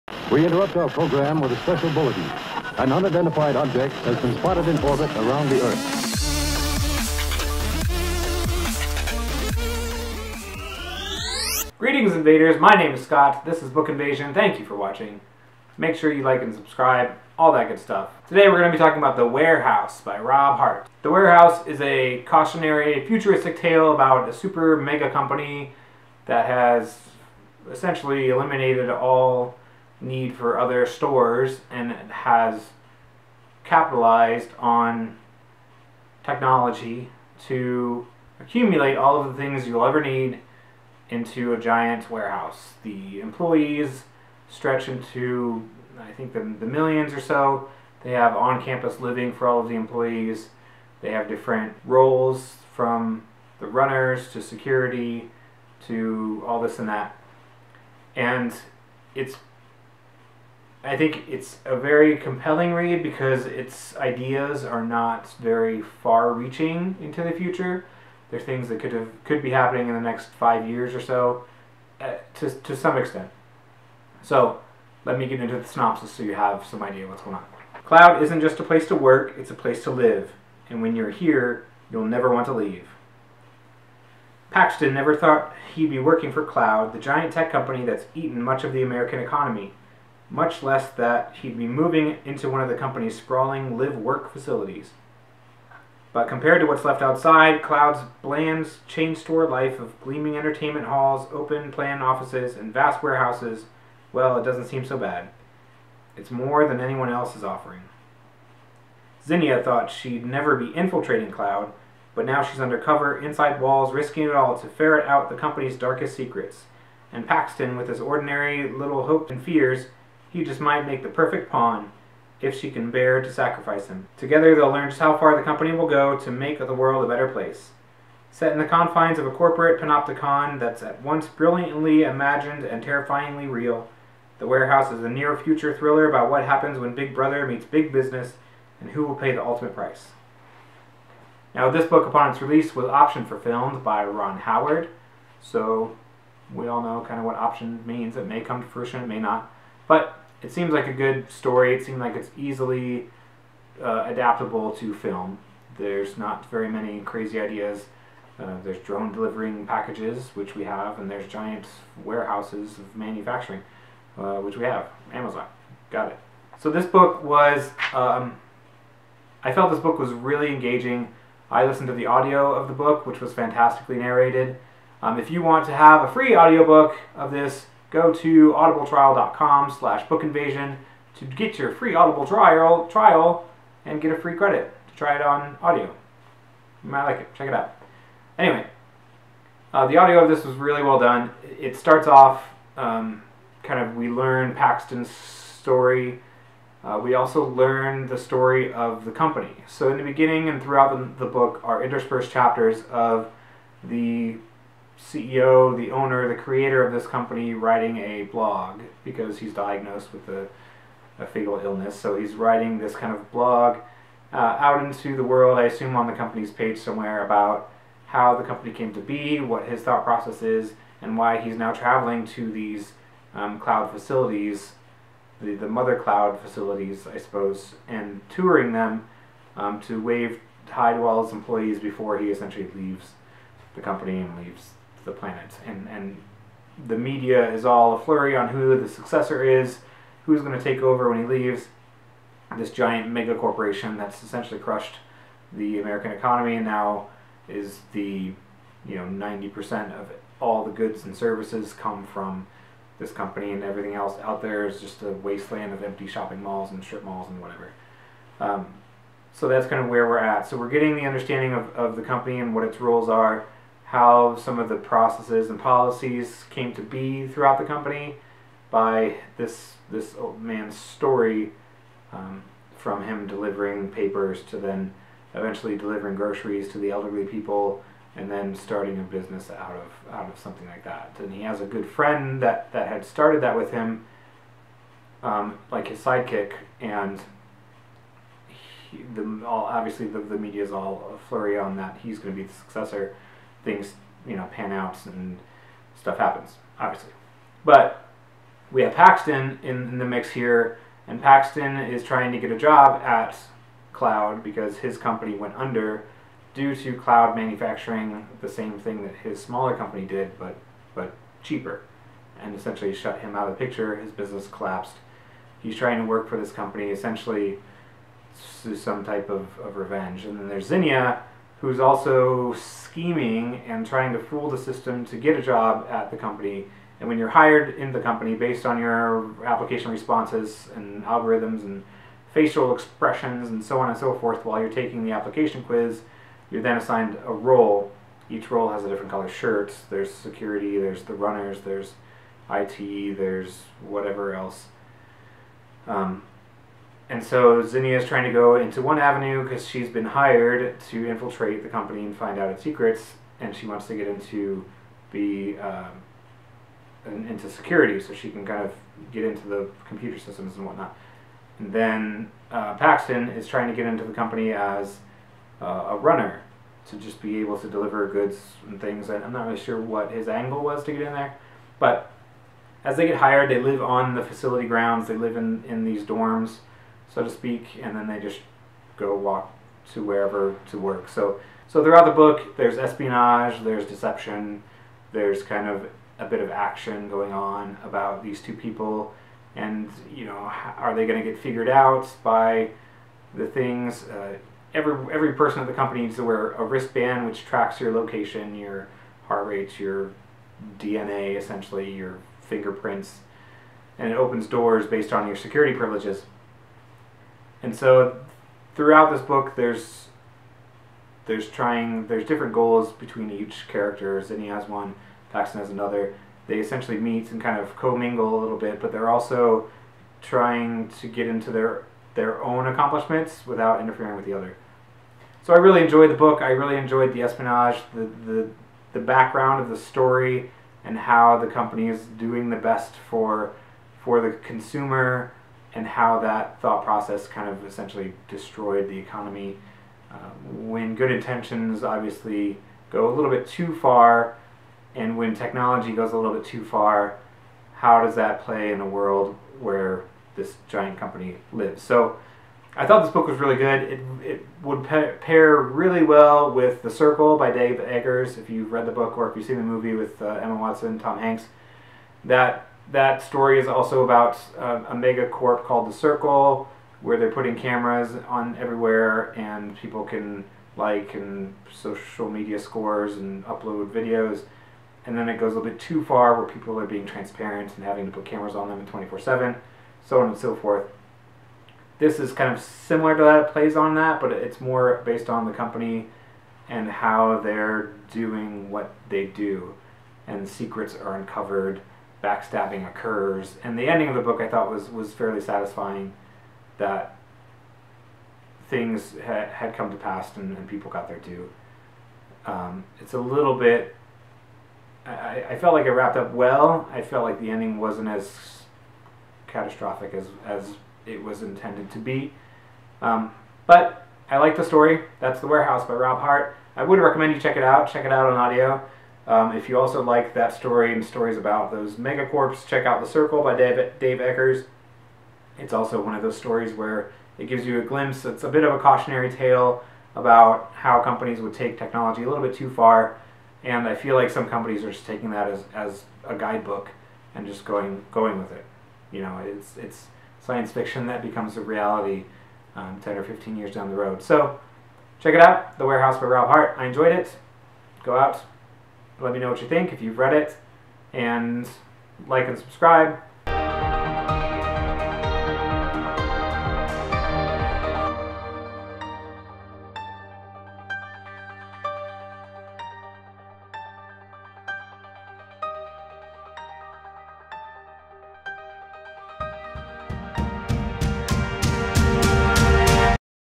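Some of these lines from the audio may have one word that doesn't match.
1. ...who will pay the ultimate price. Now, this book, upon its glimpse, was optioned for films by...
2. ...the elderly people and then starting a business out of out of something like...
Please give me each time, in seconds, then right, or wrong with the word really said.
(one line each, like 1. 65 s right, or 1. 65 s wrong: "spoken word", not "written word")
1. 138 s wrong: "release", not "glimpse"
2. 276 s right.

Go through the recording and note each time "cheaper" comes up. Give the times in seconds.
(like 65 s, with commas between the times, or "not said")
311 s.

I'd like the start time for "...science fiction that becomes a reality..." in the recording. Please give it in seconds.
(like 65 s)
540 s.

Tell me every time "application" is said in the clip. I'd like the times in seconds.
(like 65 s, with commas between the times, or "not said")
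329 s, 335 s.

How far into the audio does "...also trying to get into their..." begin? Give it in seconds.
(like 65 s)
419 s.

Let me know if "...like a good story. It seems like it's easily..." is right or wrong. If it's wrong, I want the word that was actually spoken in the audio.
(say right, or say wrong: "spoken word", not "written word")
right.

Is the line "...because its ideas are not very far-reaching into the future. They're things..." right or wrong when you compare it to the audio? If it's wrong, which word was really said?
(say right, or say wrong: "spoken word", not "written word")
right.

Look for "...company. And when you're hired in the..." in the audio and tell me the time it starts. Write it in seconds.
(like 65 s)
326 s.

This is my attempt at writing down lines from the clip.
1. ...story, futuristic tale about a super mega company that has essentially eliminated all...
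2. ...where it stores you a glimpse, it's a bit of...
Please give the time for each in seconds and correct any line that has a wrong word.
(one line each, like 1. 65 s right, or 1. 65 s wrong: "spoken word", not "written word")
1. 22 s wrong: "cautionary", not "story"
2. 526 s wrong: "gives", not "stores".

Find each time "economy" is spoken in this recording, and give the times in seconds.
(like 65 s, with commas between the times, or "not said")
89 s, 246 s, 438 s.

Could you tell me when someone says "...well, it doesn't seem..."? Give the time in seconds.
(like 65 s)
104 s.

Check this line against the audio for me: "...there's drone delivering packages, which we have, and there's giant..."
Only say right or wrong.
right.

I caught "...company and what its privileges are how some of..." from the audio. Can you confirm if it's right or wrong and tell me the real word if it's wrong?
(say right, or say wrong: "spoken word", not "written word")
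wrong: "roles", not "privileges".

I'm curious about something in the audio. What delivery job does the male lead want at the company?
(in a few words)
runner.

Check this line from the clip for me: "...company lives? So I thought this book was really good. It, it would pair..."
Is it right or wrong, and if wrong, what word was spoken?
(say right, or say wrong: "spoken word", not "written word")
right.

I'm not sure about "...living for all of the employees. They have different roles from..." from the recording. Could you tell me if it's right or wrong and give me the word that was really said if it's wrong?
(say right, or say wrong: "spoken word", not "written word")
right.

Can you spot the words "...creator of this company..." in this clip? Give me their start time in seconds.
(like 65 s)
206 s.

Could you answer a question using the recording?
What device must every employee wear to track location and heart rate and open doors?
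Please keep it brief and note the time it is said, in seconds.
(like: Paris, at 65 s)
wristband, at 396 s.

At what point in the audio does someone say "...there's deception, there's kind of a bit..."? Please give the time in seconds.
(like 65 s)
383 s.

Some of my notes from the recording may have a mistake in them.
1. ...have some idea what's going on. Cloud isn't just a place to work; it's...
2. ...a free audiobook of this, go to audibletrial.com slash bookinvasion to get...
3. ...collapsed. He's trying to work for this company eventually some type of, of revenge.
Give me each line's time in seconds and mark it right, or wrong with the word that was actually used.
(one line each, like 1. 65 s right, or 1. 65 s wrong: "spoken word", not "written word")
1. 76 s right
2. 176 s right
3. 314 s wrong: "essentially", not "eventually".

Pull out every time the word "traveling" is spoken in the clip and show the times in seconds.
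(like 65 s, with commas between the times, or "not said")
221 s.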